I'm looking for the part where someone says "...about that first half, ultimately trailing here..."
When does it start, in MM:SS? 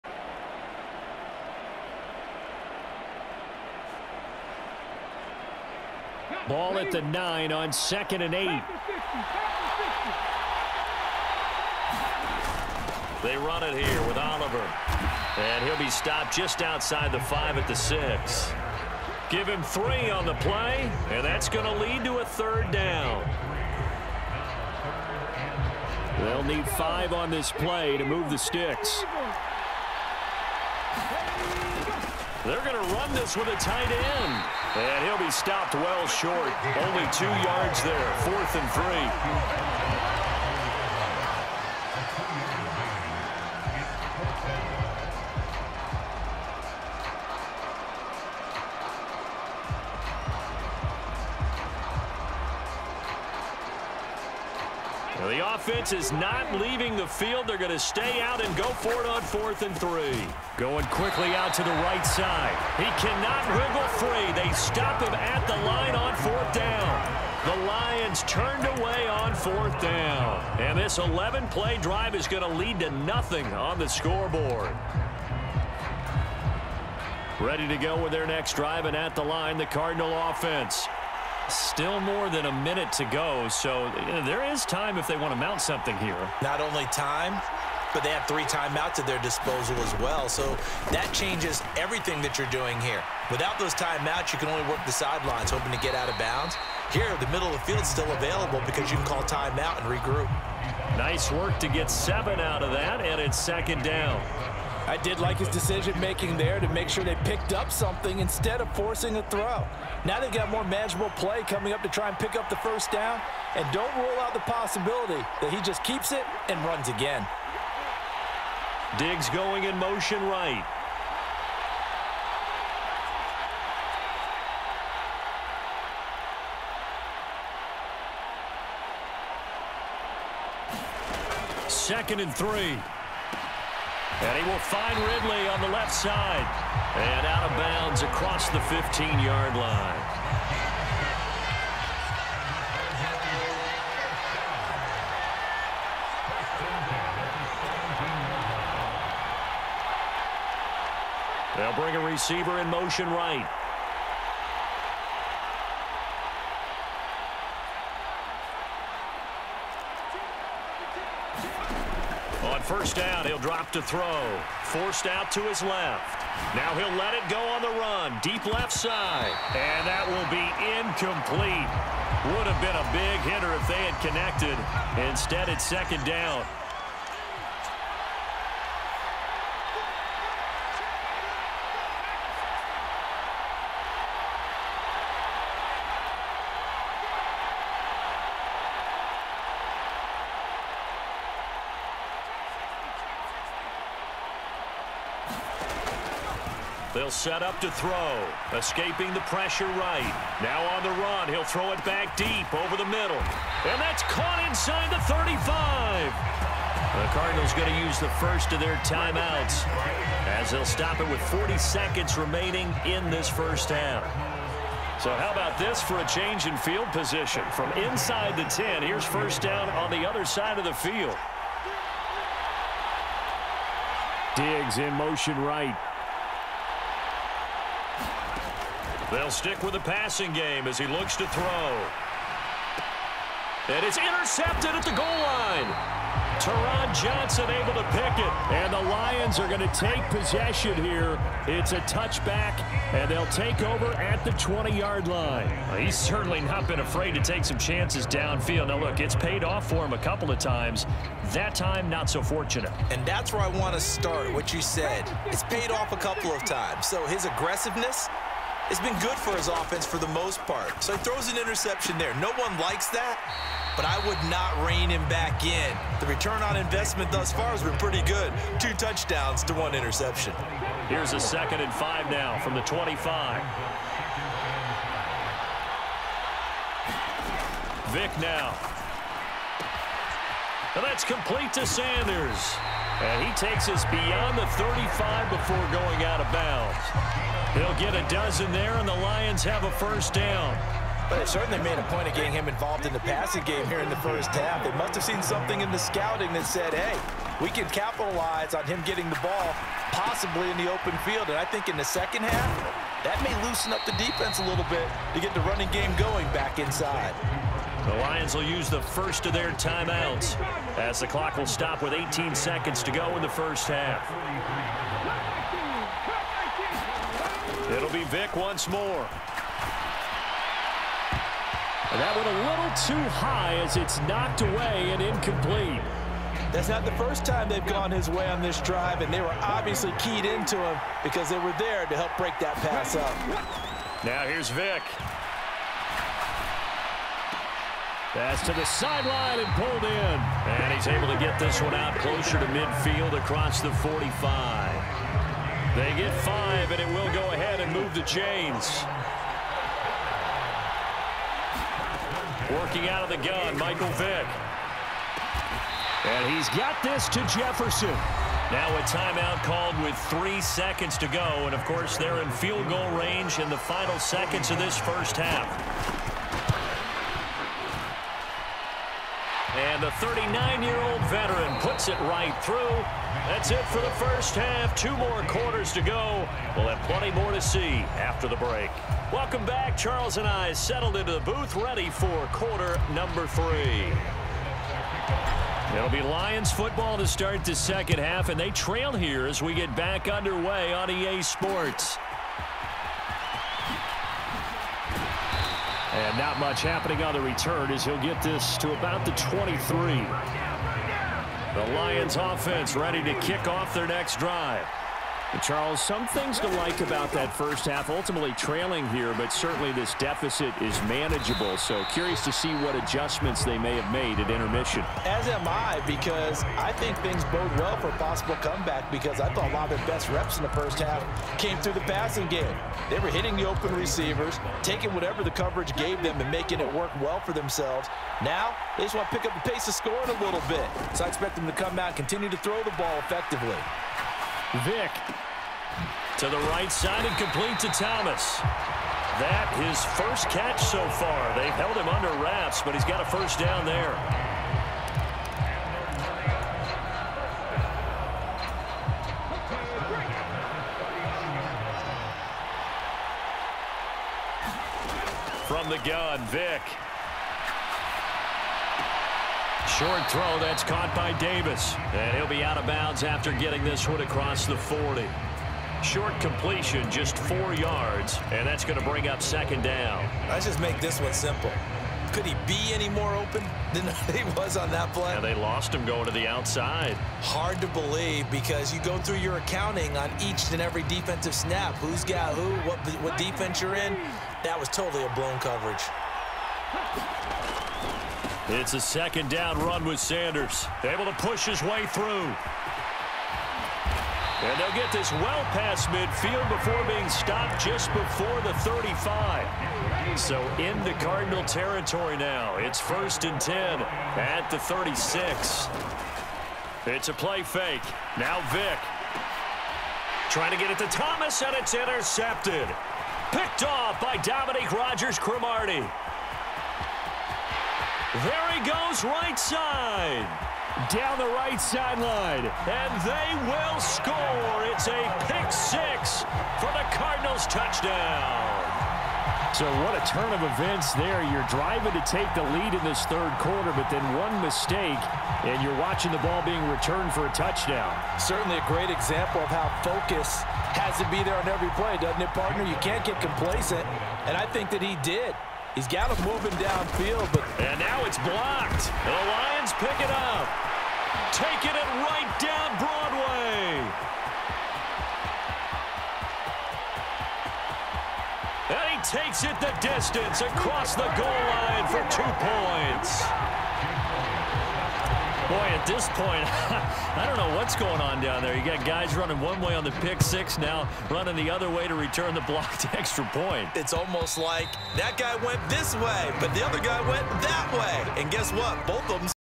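06:46.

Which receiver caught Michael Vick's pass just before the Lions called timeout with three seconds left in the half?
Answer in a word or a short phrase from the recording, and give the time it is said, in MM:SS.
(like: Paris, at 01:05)
Jefferson, at 05:57.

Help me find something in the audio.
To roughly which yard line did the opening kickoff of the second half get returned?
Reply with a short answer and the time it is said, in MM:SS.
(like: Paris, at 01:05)
23, at 06:39.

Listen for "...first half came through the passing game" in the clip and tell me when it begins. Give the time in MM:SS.
07:00.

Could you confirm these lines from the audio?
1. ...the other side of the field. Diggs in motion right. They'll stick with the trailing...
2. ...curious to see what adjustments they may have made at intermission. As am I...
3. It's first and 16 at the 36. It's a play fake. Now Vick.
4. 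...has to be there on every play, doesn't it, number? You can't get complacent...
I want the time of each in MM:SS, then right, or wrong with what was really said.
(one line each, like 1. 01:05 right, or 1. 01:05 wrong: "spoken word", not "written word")
1. 03:39 wrong: "passing", not "trailing"
2. 06:51 right
3. 08:22 wrong: "10", not "16"
4. 09:00 wrong: "partner", not "number".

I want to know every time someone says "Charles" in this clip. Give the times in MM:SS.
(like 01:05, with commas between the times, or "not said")
06:19, 06:45.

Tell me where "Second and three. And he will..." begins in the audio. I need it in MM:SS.
02:11.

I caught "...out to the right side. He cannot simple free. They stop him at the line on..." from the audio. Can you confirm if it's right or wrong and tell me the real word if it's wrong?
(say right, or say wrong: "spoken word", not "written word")
wrong: "wriggle", not "simple".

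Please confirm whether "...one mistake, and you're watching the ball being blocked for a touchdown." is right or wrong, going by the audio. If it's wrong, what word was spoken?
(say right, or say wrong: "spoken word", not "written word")
wrong: "returned", not "blocked".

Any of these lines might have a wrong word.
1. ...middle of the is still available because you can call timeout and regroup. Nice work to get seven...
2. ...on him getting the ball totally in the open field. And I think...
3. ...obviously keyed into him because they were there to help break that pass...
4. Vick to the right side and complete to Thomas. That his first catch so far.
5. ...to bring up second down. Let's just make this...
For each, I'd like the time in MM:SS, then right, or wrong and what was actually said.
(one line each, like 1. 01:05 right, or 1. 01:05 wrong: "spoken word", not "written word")
1. 01:37 right
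2. 04:58 wrong: "possibly", not "totally"
3. 05:29 right
4. 07:14 right
5. 07:48 right.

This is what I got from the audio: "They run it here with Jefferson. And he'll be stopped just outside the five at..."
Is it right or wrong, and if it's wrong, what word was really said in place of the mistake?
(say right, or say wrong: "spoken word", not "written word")
wrong: "Oliver", not "Jefferson".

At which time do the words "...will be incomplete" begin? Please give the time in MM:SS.
02:50.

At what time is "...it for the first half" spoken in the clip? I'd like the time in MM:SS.
06:13.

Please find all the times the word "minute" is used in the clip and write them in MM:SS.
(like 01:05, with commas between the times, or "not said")
01:22.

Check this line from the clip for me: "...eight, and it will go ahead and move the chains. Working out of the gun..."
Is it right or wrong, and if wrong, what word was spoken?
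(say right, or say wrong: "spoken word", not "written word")
wrong: "five", not "eight".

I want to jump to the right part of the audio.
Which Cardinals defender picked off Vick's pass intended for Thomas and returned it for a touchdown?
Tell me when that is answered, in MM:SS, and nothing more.
08:34.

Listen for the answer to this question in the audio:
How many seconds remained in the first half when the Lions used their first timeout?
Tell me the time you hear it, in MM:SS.
05:11.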